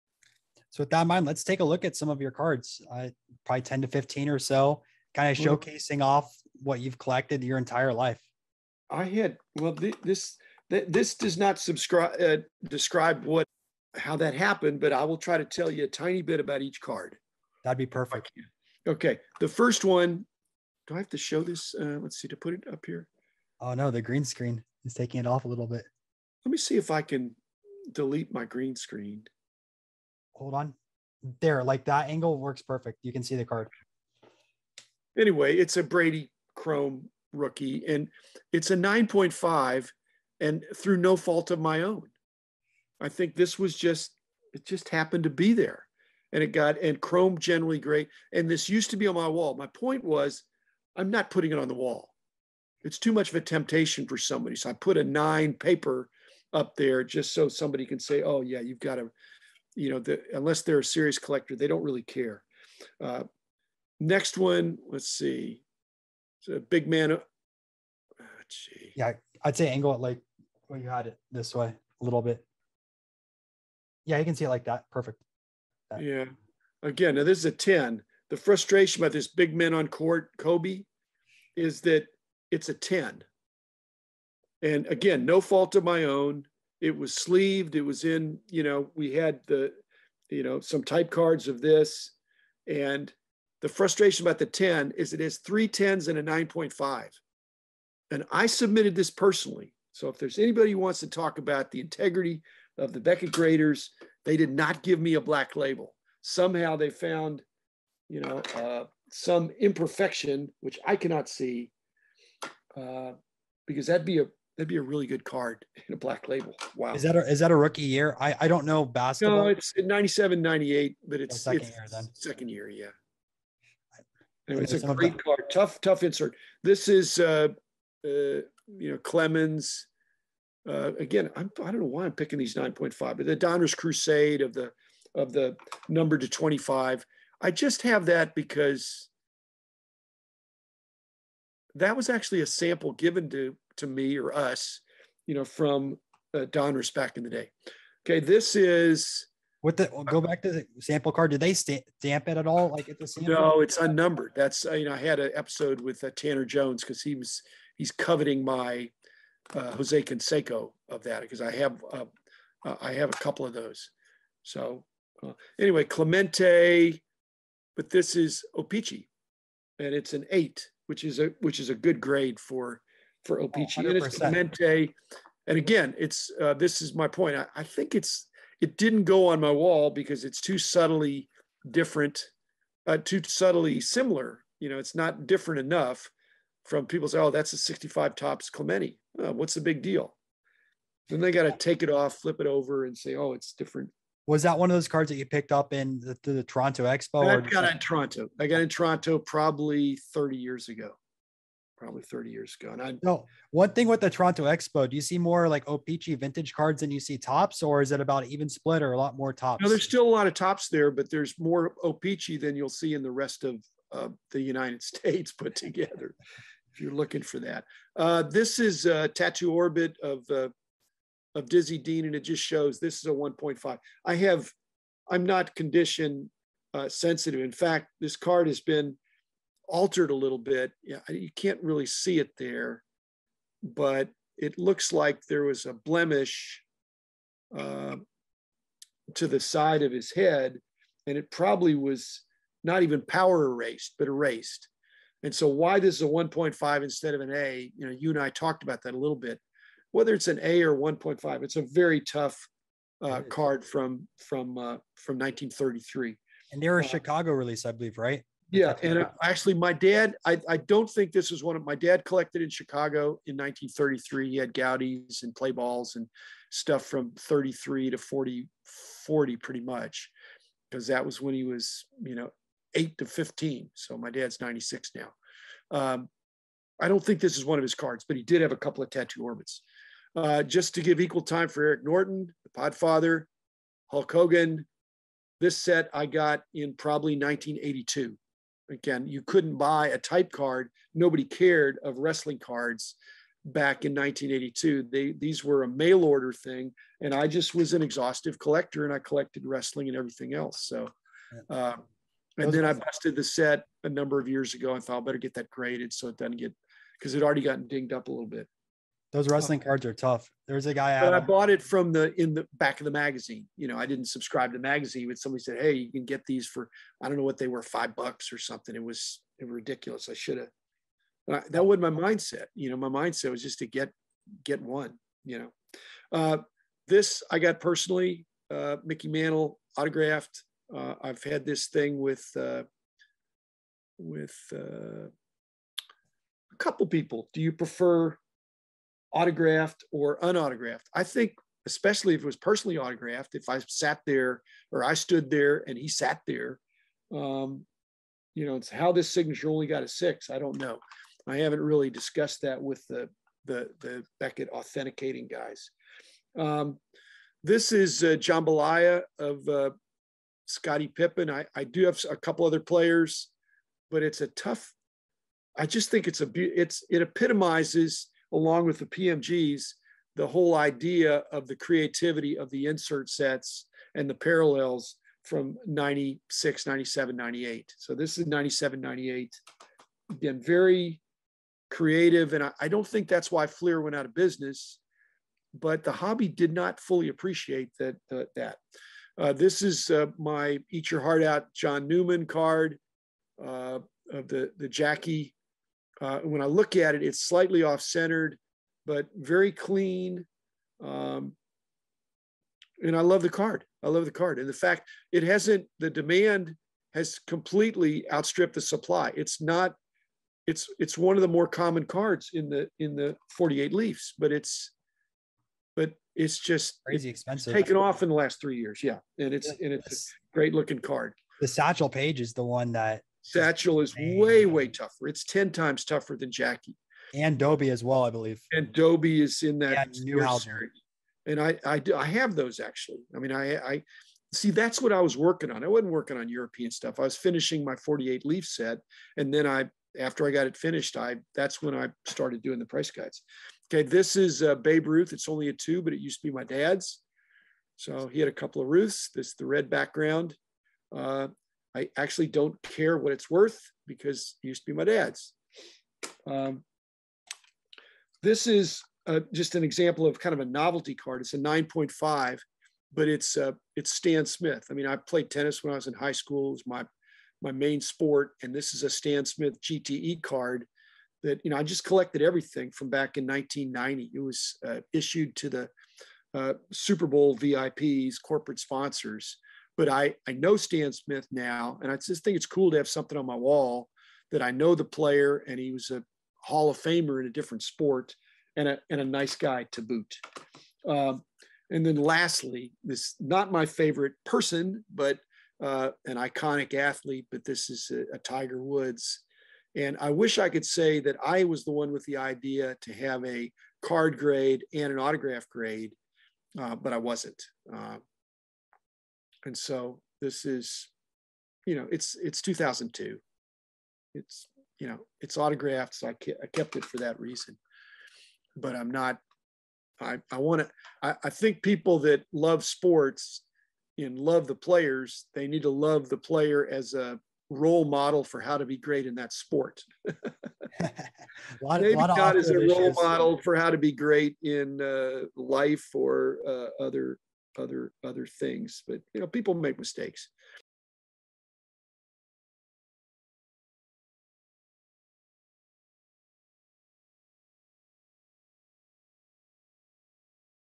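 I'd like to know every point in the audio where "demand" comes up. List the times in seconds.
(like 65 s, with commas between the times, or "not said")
405 s.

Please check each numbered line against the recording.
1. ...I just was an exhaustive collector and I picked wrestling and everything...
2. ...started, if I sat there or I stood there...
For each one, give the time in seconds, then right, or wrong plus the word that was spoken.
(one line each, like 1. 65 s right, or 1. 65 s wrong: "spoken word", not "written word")
1. 297 s wrong: "collected", not "picked"
2. 342 s wrong: "autographed", not "started".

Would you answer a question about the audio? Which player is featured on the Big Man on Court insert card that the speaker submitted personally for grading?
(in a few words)
Kobe.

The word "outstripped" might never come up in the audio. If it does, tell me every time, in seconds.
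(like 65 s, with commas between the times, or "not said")
408 s.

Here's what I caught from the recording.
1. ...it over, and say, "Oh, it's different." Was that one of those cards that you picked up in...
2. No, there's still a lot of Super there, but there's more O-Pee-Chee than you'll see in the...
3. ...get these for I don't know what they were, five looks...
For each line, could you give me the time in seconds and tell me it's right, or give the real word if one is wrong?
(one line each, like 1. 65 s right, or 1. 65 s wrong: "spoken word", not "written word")
1. 192 s right
2. 209 s wrong: "Topps", not "Super"
3. 316 s wrong: "bucks", not "looks".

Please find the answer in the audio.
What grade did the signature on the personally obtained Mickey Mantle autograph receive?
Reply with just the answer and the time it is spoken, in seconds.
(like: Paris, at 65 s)
6, at 349 s.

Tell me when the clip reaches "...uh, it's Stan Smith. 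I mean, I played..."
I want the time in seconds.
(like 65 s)
463 s.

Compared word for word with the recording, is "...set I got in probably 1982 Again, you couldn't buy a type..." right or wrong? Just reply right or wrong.
right.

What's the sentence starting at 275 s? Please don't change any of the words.
Um, I don't think this is one of his cards, but he did have a couple of tattoo orbits.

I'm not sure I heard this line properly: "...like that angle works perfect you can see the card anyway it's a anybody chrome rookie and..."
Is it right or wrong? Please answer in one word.
wrong.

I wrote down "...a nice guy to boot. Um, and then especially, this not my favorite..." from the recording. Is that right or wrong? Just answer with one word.
wrong.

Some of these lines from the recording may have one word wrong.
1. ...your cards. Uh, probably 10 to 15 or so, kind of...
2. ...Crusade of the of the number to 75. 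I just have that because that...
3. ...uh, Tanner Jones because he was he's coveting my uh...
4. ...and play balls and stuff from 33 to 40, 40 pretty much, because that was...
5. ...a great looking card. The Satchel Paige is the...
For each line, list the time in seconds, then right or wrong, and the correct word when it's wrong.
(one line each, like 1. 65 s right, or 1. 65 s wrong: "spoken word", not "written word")
1. 2 s right
2. 133 s wrong: "25", not "75"
3. 156 s right
4. 265 s right
5. 420 s right.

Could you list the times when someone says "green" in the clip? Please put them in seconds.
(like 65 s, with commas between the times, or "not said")
24 s, 28 s.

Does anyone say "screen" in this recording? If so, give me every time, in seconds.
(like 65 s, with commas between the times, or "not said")
24 s, 28 s.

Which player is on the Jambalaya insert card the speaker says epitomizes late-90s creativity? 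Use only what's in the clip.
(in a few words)
Scottie Pippen.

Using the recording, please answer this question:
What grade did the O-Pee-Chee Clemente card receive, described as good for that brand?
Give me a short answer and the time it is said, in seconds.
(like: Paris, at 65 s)
8, at 169 s.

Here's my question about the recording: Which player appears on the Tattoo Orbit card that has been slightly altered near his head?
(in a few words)
Dizzy Dean.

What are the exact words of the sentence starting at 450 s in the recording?
Uh, I actually don't care what it's worth because it used to be my dad's.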